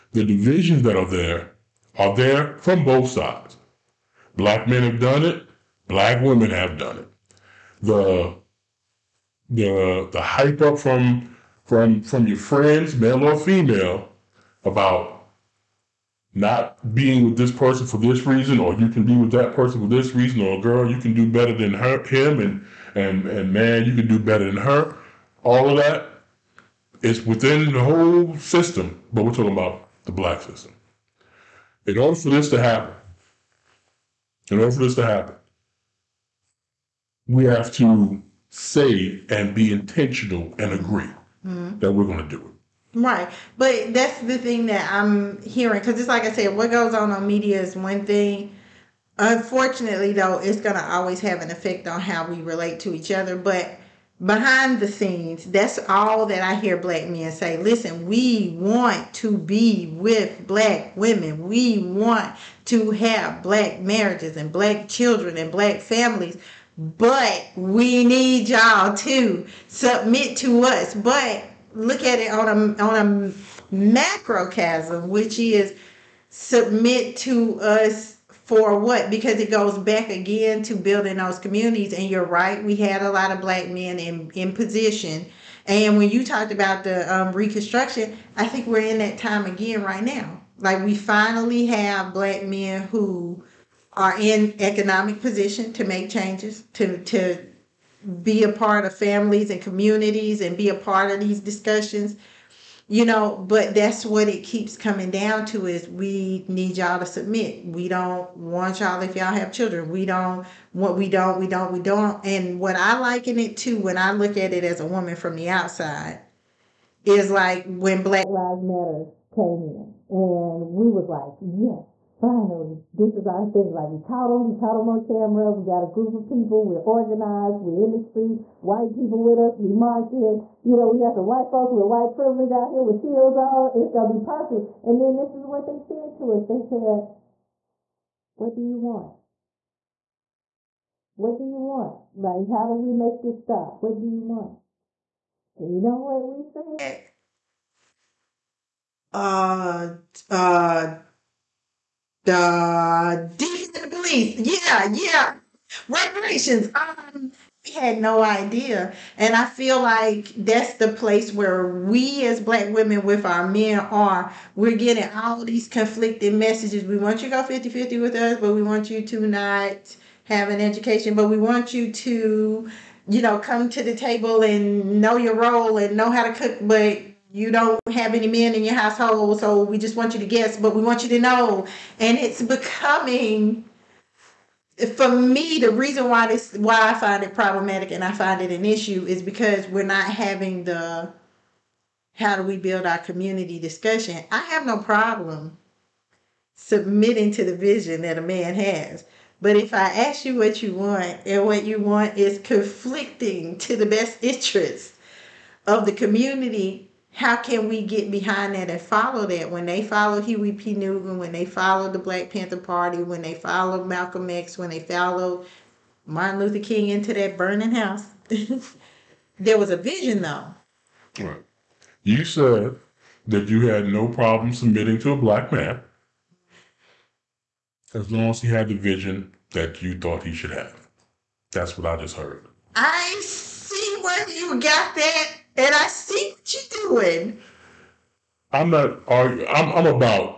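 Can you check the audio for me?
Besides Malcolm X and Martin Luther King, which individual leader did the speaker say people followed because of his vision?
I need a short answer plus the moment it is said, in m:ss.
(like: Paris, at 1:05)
Huey P. Newton, at 3:30.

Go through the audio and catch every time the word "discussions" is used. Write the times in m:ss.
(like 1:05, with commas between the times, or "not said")
1:41, 3:13.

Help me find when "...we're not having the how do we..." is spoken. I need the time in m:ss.
3:09.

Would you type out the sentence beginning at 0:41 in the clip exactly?
that we're going to do it.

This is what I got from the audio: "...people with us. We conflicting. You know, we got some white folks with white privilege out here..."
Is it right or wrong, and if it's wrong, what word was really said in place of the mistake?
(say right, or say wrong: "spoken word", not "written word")
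wrong: "marching", not "conflicting".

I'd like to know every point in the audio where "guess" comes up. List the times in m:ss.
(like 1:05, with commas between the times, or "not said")
3:00.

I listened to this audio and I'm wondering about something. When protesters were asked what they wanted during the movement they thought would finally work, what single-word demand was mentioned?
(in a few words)
Reparations.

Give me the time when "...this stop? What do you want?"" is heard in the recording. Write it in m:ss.
2:23.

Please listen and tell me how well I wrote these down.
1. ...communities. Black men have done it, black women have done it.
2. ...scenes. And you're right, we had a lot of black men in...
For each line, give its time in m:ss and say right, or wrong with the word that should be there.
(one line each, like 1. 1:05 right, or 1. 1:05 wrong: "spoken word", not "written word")
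1. 0:03 wrong: "sides", not "communities"
2. 1:21 wrong: "communities", not "scenes".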